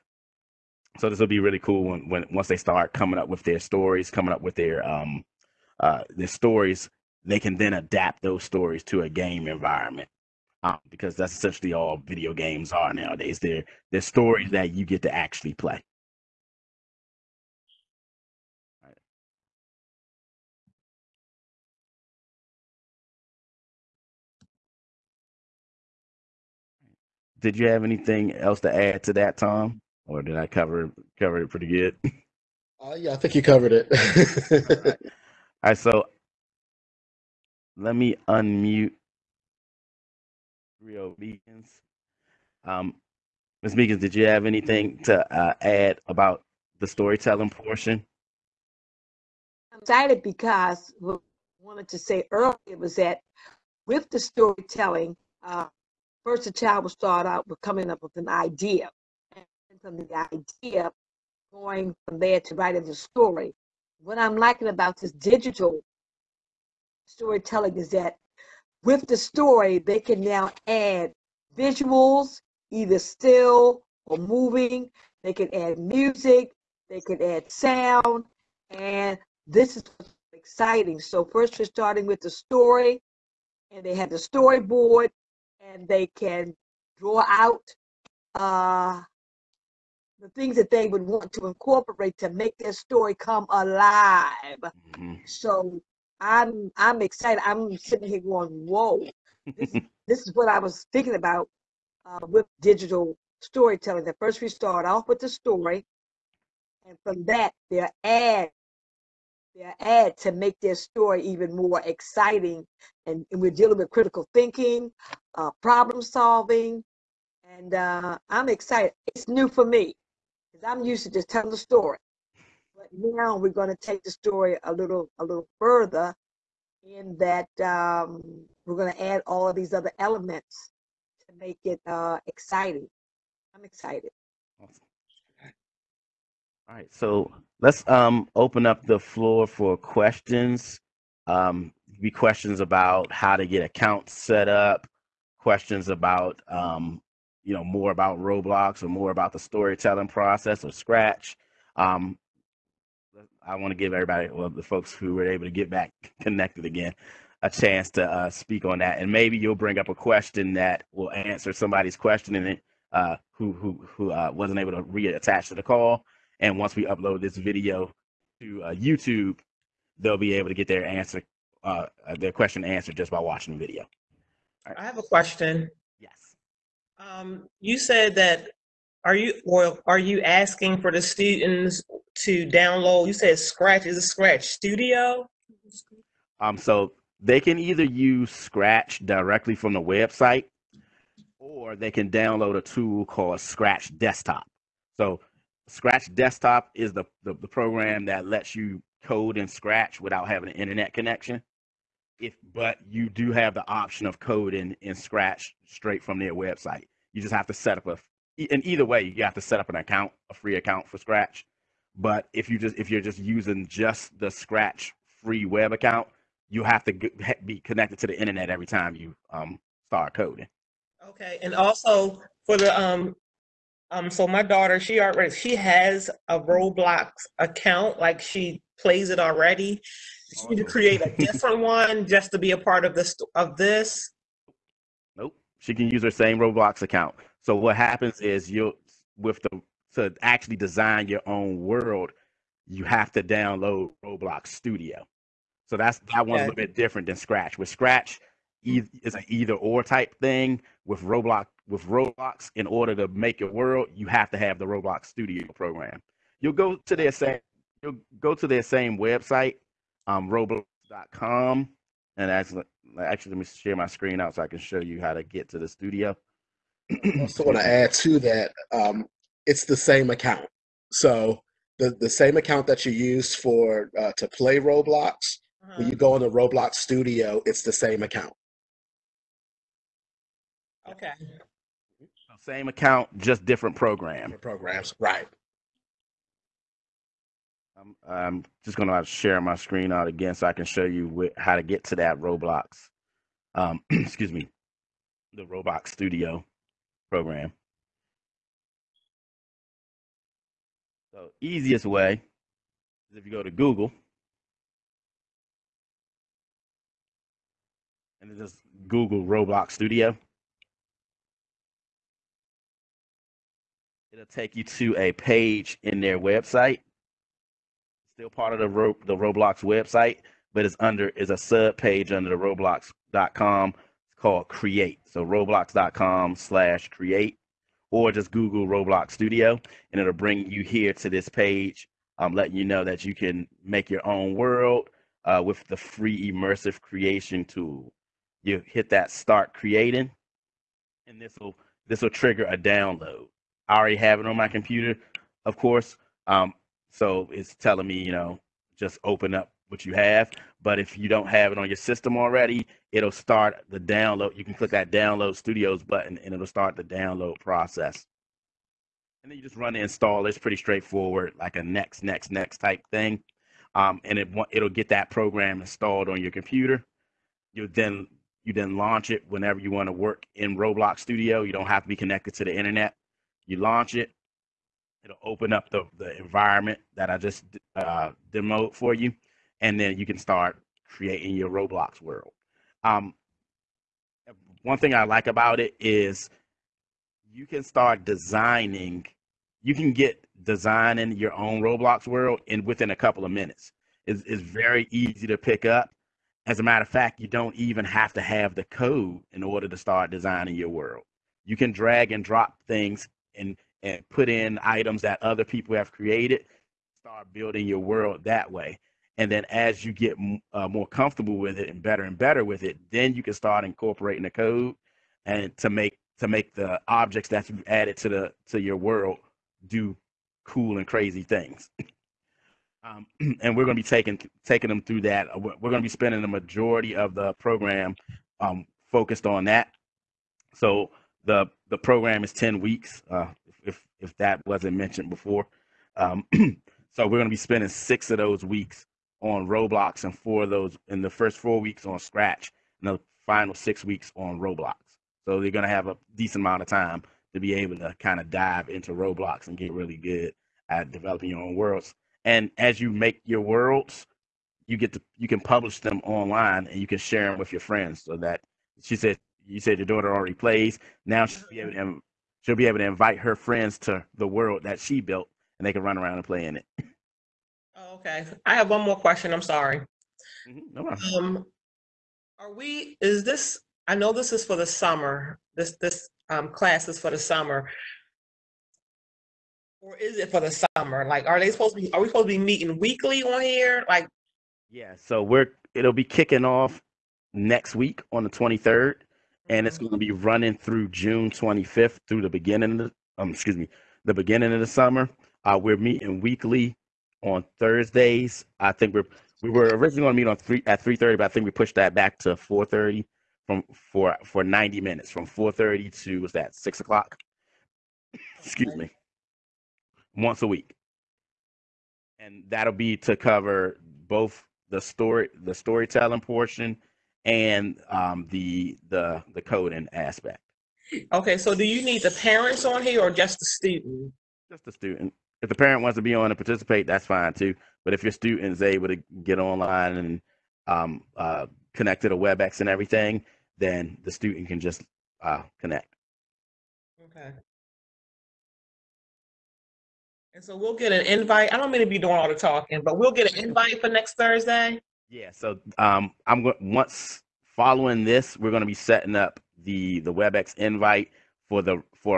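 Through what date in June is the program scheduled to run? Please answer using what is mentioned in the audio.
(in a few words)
June 25th.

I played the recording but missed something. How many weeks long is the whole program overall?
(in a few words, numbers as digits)
10.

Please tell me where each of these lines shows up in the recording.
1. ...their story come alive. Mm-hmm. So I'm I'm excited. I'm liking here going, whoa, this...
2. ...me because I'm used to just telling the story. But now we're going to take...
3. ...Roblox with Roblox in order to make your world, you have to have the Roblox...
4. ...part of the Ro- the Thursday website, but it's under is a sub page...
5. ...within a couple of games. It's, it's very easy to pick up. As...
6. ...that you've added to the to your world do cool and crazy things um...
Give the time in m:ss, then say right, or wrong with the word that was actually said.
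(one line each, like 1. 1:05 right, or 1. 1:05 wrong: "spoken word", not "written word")
1. 1:32 wrong: "sitting", not "liking"
2. 1:59 right
3. 4:11 right
4. 5:18 wrong: "Roblox", not "Thursday"
5. 6:32 wrong: "minutes", not "games"
6. 6:57 right.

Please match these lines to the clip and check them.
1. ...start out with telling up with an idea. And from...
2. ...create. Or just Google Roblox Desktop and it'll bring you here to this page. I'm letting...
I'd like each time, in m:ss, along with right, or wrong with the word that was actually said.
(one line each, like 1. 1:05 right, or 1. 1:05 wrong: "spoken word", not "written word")
1. 0:56 wrong: "coming", not "telling"
2. 5:26 wrong: "Studio", not "Desktop".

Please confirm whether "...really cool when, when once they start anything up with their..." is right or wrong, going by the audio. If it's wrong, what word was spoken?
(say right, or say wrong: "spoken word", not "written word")
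wrong: "coming", not "anything".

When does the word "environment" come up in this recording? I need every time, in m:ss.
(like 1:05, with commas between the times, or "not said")
0:09, 6:16.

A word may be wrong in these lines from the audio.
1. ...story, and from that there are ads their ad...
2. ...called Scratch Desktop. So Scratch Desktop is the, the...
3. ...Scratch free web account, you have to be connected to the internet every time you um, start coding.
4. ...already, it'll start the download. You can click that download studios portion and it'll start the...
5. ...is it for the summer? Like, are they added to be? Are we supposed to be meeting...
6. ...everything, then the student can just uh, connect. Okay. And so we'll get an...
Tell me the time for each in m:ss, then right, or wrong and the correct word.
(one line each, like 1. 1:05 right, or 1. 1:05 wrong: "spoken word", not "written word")
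1. 1:45 right
2. 3:13 right
3. 3:34 right
4. 5:52 wrong: "button", not "portion"
5. 7:59 wrong: "supposed", not "added"
6. 8:52 right.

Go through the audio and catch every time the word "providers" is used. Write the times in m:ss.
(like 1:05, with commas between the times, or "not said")
not said.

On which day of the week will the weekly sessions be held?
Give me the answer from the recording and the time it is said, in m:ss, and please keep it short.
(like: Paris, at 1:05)
Thursdays, at 8:17.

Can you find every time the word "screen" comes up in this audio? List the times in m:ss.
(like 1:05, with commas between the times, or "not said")
4:23, 4:49.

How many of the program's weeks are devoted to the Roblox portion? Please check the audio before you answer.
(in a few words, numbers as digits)
6.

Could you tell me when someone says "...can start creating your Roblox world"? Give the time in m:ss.
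6:20.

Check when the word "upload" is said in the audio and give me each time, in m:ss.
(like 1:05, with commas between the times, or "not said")
2:46.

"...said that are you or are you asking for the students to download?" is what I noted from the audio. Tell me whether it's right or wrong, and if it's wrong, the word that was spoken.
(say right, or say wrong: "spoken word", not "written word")
right.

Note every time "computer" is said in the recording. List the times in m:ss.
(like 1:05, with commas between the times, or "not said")
5:44, 6:06.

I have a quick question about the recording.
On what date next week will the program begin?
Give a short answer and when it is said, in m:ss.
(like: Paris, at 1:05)
the 23rd, at 8:08.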